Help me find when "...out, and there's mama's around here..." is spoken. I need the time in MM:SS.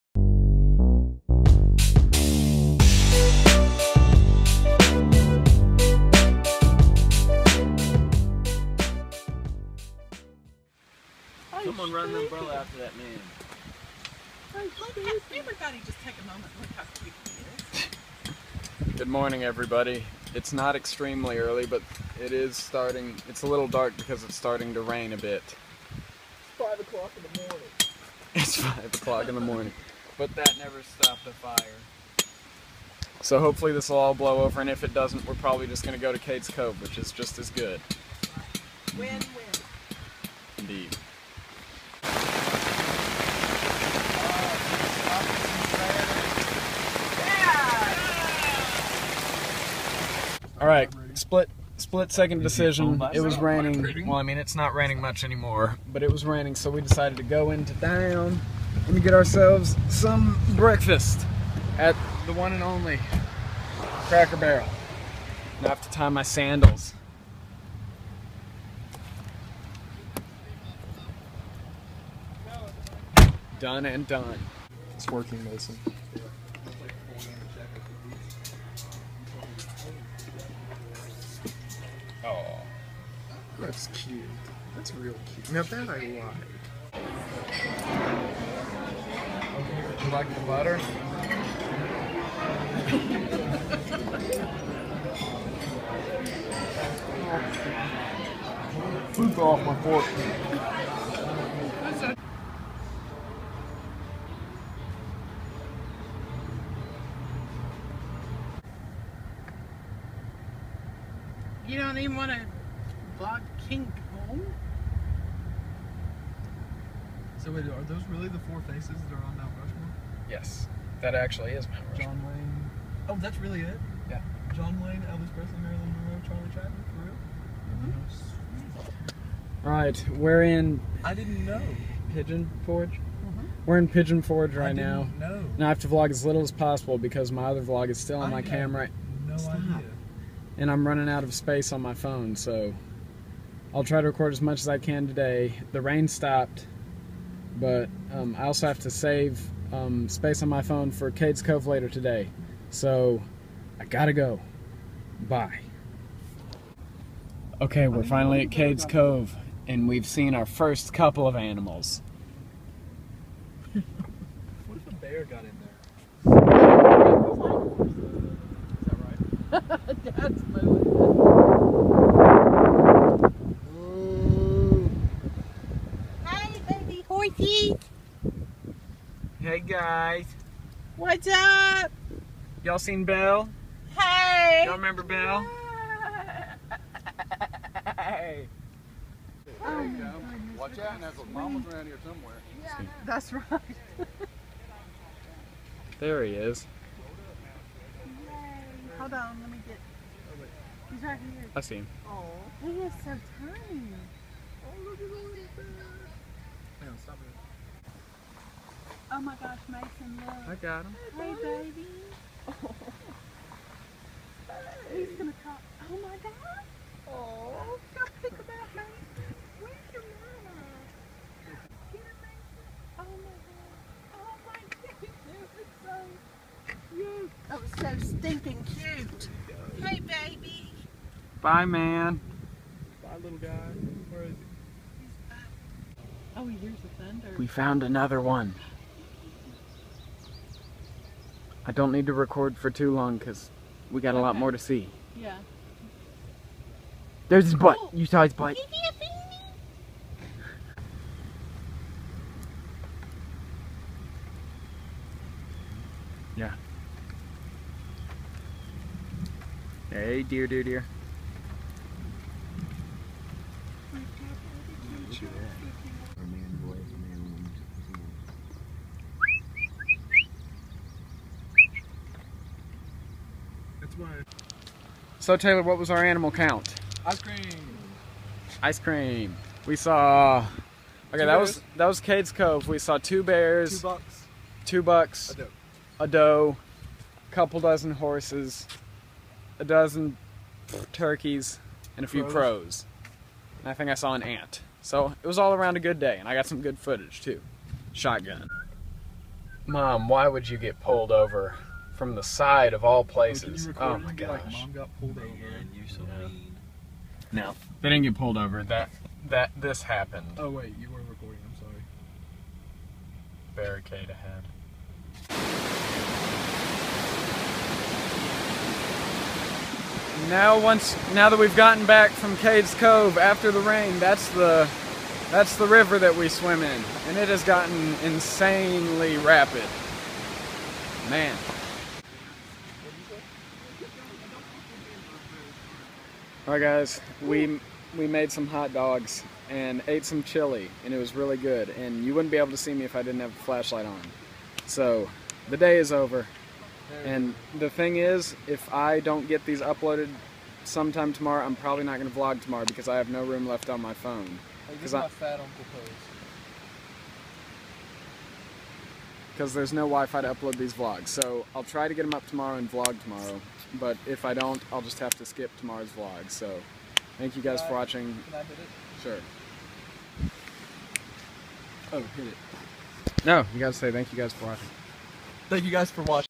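03:10.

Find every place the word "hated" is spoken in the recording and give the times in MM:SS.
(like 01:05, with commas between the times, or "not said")
not said.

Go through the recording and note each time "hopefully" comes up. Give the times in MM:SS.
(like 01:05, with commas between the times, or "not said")
00:33.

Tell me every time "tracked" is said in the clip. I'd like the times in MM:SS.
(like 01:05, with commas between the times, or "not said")
not said.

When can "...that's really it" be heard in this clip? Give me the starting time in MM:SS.
02:03.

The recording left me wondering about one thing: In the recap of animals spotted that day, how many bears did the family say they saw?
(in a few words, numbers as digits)
2.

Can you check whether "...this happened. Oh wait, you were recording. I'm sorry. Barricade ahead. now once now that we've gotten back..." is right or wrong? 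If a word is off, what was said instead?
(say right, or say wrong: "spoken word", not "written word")
right.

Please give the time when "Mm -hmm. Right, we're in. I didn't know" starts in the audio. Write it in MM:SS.
02:08.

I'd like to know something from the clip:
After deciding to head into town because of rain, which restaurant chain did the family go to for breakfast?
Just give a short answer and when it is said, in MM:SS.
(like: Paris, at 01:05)
Cracker Barrel, at 01:04.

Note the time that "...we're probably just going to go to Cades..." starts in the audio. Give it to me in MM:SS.
00:35.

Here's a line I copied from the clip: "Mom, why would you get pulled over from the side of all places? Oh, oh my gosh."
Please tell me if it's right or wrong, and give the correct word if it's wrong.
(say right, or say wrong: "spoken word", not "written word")
right.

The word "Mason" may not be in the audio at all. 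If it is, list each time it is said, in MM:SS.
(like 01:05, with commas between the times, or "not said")
01:15, 03:29.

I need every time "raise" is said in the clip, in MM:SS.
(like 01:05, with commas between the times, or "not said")
not said.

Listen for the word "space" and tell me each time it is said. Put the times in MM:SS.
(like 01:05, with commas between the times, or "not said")
02:21, 02:30.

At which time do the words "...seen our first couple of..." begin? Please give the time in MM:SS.
02:40.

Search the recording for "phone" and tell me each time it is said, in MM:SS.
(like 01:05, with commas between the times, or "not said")
02:21, 02:30, 05:53.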